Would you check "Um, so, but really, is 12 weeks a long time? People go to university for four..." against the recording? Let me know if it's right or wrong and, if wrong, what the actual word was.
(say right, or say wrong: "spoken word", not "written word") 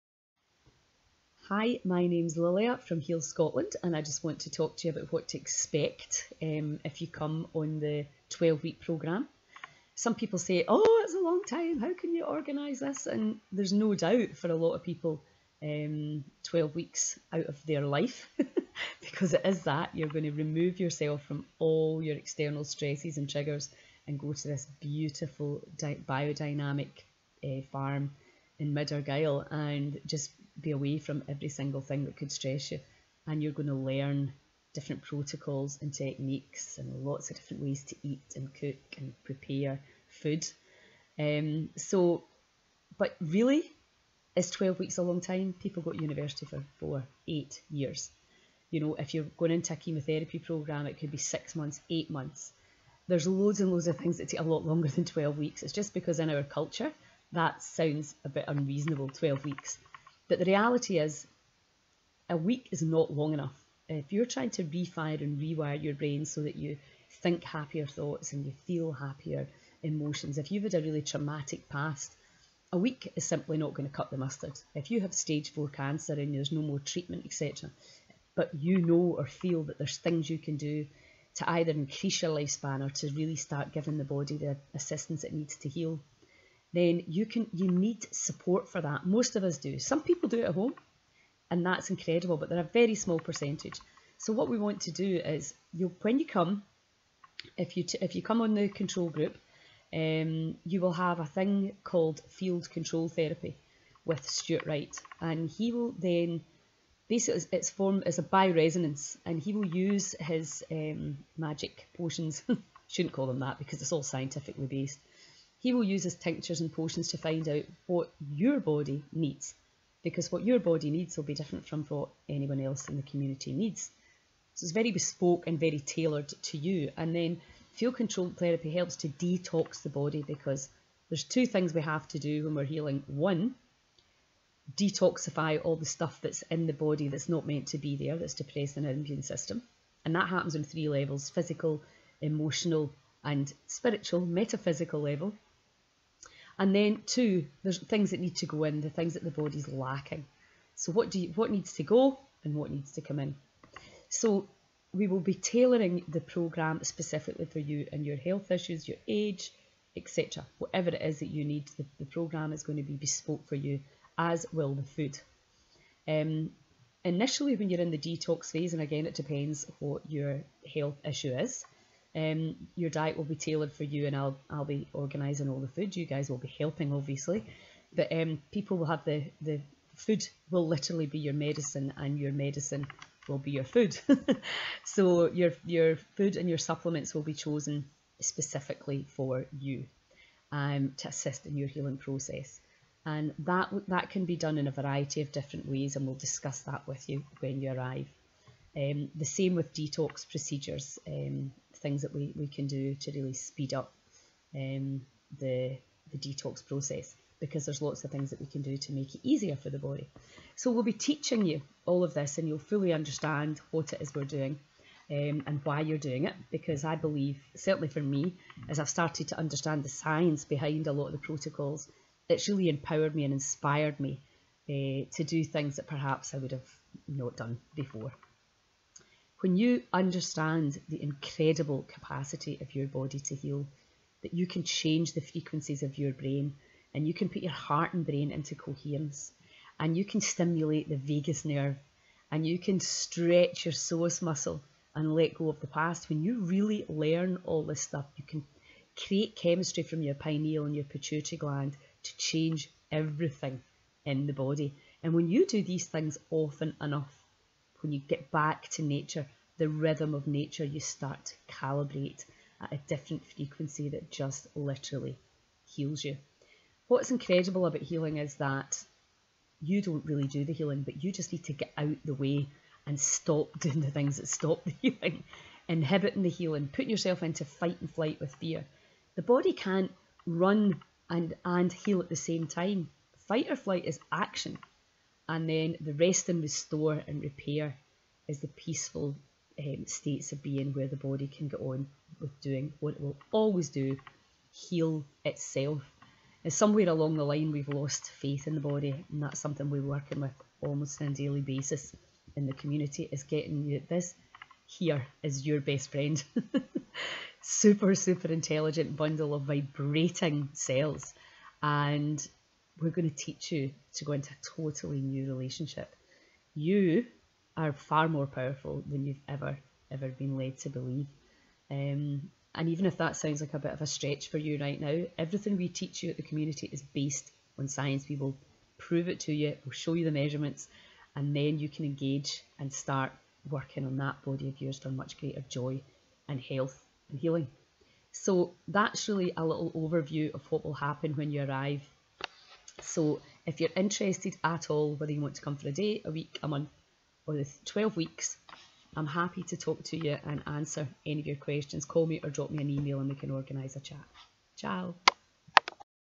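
right.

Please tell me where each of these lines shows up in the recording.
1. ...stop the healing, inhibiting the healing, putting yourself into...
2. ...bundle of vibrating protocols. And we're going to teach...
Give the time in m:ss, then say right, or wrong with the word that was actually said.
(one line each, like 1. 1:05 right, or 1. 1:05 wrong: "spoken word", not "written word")
1. 4:34 right
2. 5:08 wrong: "cells", not "protocols".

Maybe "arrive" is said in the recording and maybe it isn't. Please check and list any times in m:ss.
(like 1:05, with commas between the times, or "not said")
3:17, 5:41.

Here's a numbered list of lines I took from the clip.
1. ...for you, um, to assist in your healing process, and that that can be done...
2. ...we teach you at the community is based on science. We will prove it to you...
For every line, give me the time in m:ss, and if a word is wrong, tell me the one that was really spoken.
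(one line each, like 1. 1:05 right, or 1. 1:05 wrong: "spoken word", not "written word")
1. 3:09 right
2. 5:25 right.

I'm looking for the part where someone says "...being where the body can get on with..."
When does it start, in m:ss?
4:50.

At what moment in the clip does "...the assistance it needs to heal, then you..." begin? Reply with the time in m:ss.
1:24.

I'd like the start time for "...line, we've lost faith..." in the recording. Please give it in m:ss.
4:57.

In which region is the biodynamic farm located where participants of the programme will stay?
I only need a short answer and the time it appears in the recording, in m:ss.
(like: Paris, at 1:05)
Mid Argyll, at 0:28.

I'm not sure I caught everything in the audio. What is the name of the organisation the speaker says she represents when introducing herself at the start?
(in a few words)
Heal Scotland.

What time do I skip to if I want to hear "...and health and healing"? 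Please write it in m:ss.
5:36.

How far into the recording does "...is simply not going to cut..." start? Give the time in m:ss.
1:13.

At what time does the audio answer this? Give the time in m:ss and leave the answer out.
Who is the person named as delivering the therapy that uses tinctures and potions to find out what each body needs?
1:44.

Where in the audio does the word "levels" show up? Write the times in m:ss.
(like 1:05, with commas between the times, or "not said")
2:20, 2:25.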